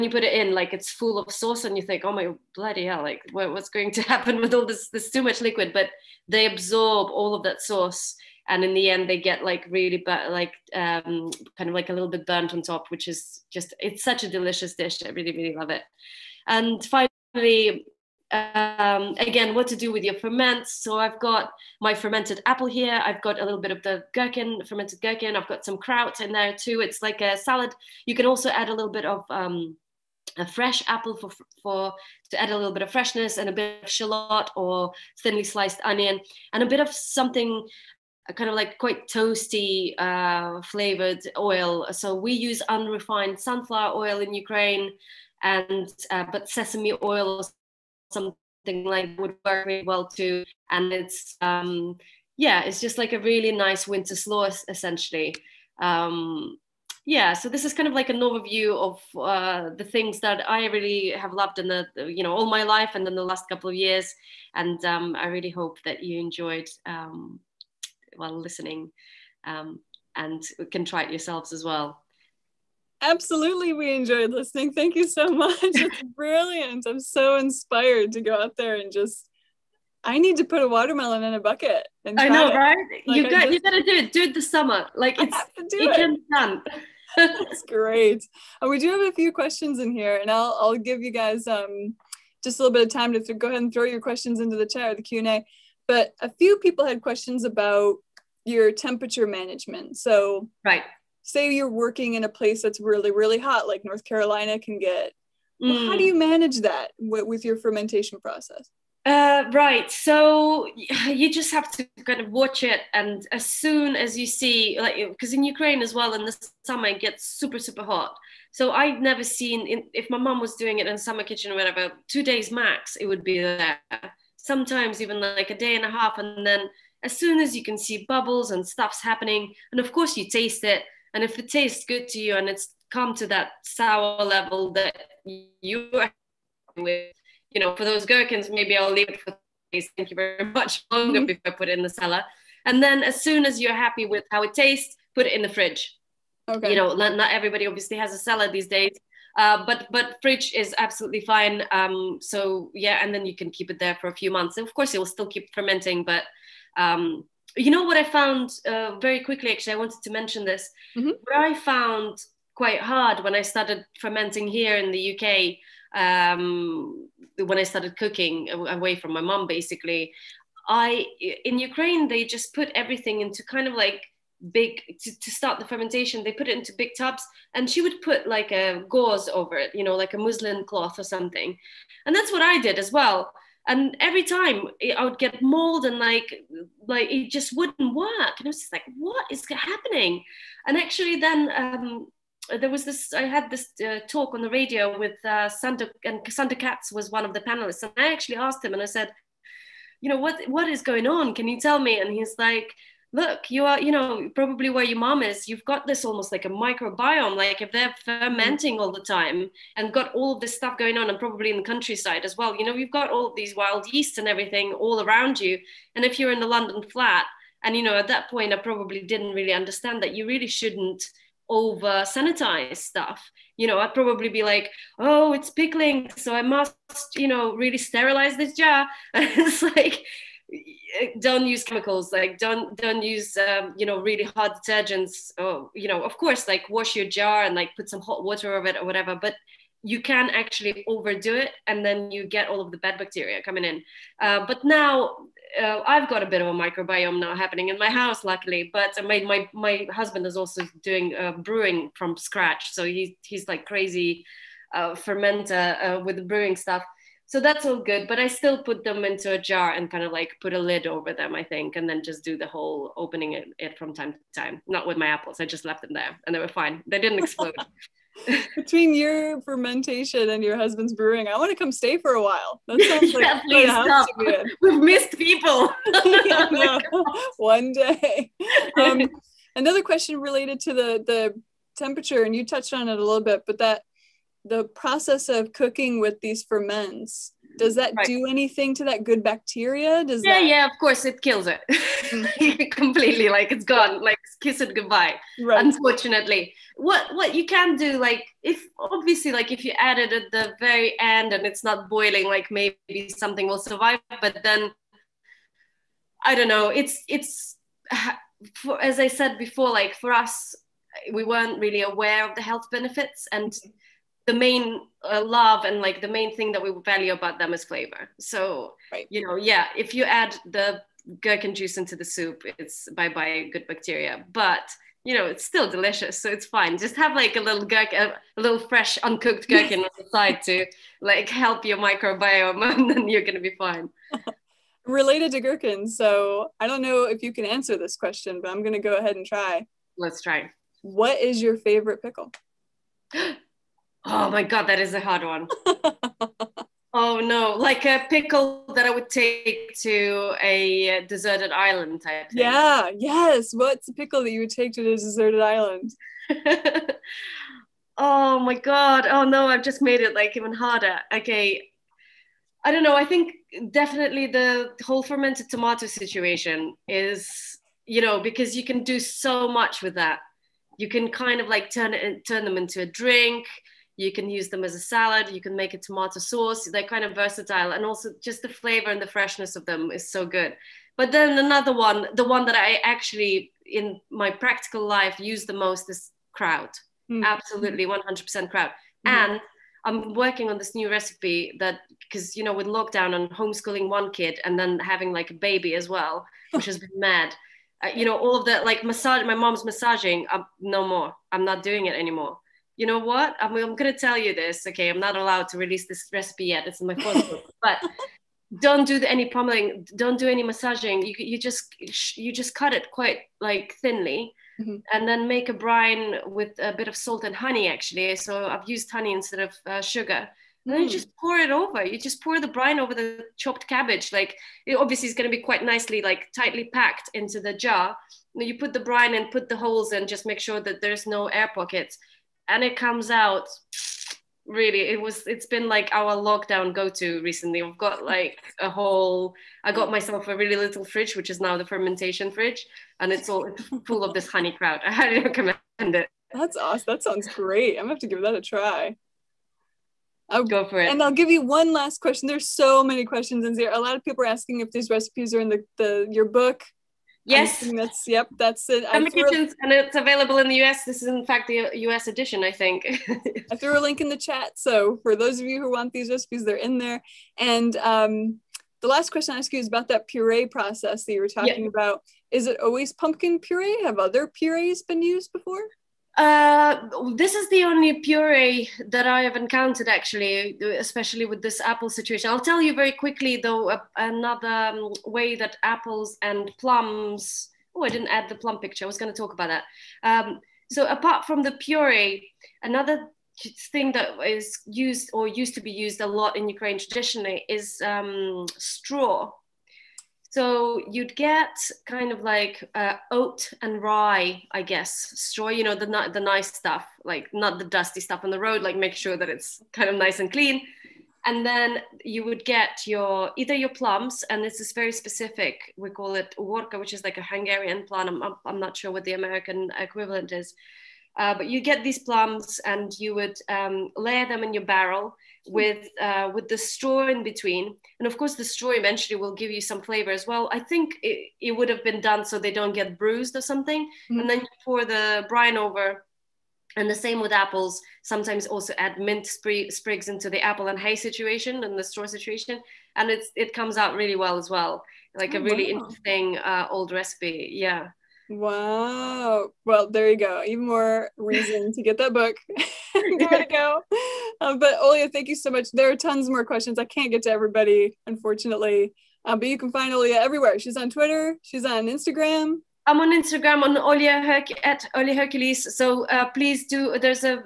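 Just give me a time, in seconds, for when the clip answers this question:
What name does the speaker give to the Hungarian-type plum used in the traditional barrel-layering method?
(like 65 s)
516 s.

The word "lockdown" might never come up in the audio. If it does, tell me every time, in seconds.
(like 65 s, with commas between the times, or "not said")
392 s, 436 s.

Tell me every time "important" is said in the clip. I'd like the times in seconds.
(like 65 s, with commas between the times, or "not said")
not said.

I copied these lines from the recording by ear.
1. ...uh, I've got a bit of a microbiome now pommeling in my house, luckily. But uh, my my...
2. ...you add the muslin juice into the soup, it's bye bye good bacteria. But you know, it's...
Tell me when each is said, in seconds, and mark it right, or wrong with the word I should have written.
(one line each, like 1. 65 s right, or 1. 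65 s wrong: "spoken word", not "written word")
1. 245 s wrong: "happening", not "pommeling"
2. 319 s wrong: "gherkin", not "muslin".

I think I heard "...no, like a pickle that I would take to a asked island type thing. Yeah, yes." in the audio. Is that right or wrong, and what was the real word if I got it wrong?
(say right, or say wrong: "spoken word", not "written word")
wrong: "deserted", not "asked".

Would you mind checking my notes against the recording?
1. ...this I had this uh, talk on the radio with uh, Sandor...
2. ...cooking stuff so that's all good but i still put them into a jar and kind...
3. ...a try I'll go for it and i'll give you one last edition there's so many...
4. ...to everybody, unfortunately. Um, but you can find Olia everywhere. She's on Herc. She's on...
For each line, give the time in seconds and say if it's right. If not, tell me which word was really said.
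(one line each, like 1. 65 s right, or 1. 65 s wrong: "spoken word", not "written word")
1. 192 s right
2. 256 s wrong: "brewing", not "cooking"
3. 448 s wrong: "question", not "edition"
4. 557 s wrong: "Twitter", not "Herc".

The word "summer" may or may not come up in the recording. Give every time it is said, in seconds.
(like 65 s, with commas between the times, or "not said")
84 s, 116 s, 120 s.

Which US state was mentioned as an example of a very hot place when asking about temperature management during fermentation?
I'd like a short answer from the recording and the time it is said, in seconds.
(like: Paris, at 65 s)
North Carolina, at 103 s.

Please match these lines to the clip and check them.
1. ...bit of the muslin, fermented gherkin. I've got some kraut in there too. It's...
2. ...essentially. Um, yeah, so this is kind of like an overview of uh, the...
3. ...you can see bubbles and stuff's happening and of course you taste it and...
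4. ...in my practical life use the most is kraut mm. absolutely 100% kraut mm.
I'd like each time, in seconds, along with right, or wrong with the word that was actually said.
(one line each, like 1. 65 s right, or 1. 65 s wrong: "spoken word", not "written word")
1. 23 s wrong: "gherkin", not "muslin"
2. 54 s right
3. 127 s right
4. 383 s right.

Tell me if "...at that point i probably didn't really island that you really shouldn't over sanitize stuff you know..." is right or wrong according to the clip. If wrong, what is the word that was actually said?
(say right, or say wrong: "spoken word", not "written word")
wrong: "understand", not "island".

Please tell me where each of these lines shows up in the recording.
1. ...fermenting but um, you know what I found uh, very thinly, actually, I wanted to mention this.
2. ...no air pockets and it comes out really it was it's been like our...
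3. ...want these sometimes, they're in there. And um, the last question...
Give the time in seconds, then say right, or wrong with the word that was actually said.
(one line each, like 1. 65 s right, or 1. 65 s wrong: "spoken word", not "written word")
1. 155 s wrong: "quickly", not "thinly"
2. 431 s right
3. 465 s wrong: "recipes", not "sometimes".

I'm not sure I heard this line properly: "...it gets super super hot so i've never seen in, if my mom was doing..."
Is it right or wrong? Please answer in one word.
right.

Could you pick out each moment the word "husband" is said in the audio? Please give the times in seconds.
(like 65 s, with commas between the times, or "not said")
249 s, 270 s.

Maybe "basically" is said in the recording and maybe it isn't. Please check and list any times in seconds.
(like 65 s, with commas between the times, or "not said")
169 s.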